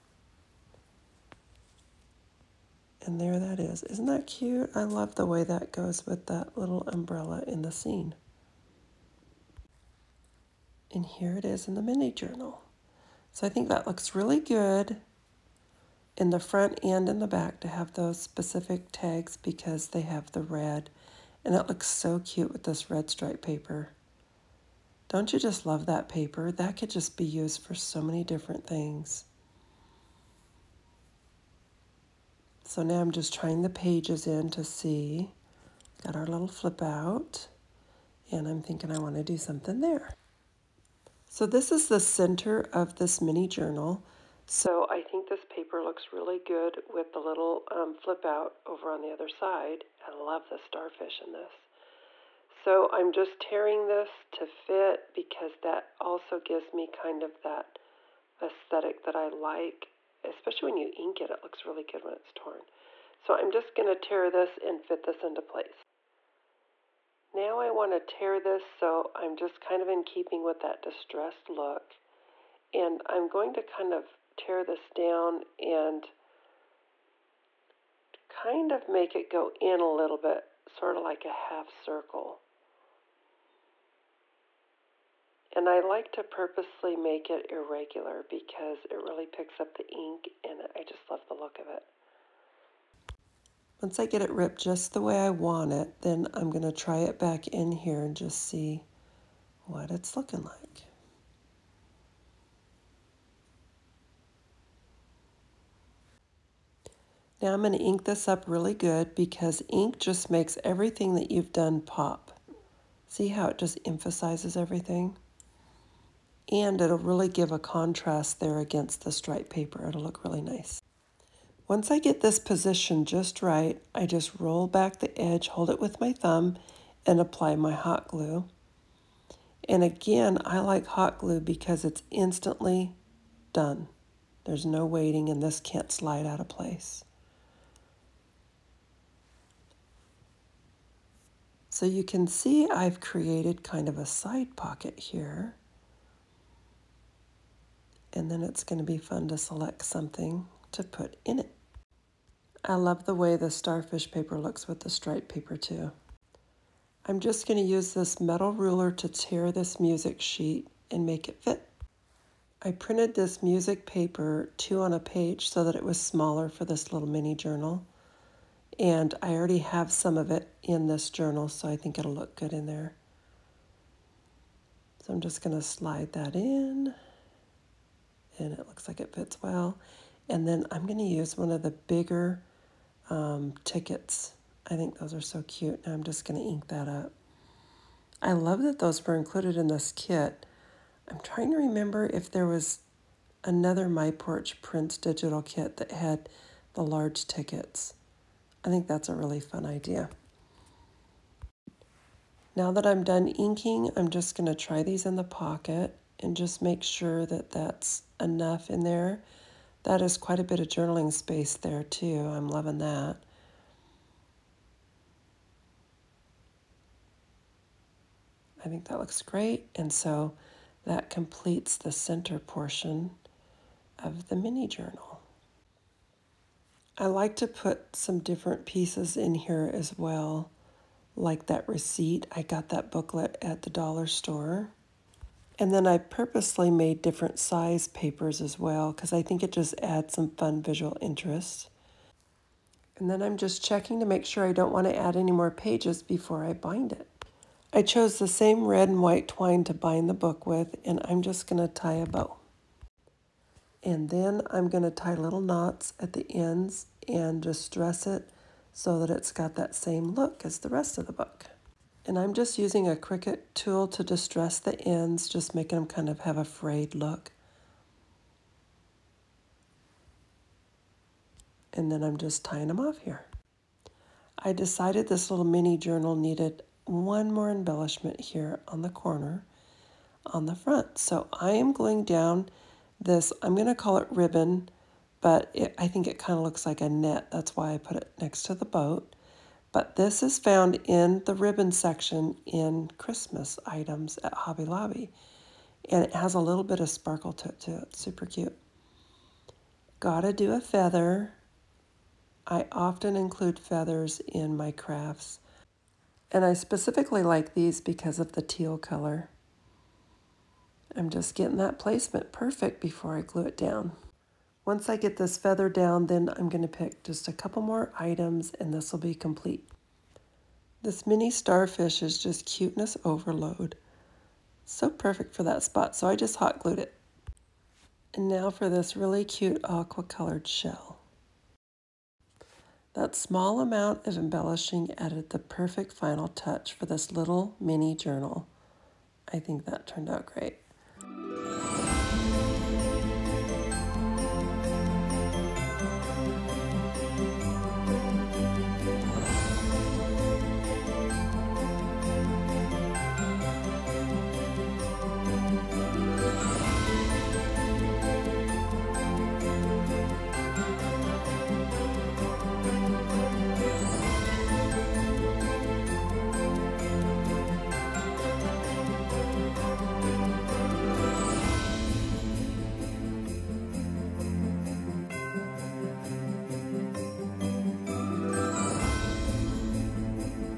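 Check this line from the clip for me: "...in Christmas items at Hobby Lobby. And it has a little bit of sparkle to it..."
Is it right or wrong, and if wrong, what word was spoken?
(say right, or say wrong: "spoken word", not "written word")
right.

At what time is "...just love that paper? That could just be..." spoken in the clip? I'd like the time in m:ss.
0:25.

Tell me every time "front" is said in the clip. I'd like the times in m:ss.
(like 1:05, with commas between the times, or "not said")
0:16, 4:40.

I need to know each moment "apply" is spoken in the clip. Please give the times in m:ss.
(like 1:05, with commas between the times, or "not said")
2:07.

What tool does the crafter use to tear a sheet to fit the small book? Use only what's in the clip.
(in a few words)
metal ruler.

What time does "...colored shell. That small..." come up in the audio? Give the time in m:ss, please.
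5:30.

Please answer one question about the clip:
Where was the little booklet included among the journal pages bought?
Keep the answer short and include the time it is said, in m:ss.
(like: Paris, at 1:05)
the dollar store, at 3:53.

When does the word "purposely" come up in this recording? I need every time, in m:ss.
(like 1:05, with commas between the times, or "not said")
1:26, 3:55.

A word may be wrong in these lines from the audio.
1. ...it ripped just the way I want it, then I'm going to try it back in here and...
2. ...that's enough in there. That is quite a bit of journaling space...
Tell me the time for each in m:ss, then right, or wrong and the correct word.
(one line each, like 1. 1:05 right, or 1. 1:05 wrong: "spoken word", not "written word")
1. 1:34 right
2. 3:27 right.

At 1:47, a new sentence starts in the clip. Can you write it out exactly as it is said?
Now I'm going to ink this up really good because ink just makes everything that you've done pop.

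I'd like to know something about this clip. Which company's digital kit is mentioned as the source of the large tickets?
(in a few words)
My Porch Prints.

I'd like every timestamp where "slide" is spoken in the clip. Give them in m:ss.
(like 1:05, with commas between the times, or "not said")
2:15, 2:55.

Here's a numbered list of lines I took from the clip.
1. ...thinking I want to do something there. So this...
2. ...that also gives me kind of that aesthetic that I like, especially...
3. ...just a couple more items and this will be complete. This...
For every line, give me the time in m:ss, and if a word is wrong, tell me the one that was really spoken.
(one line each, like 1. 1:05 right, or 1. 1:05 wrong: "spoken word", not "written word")
1. 0:38 right
2. 0:55 right
3. 5:17 right.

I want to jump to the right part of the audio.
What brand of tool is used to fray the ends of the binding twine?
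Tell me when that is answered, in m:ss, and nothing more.
4:22.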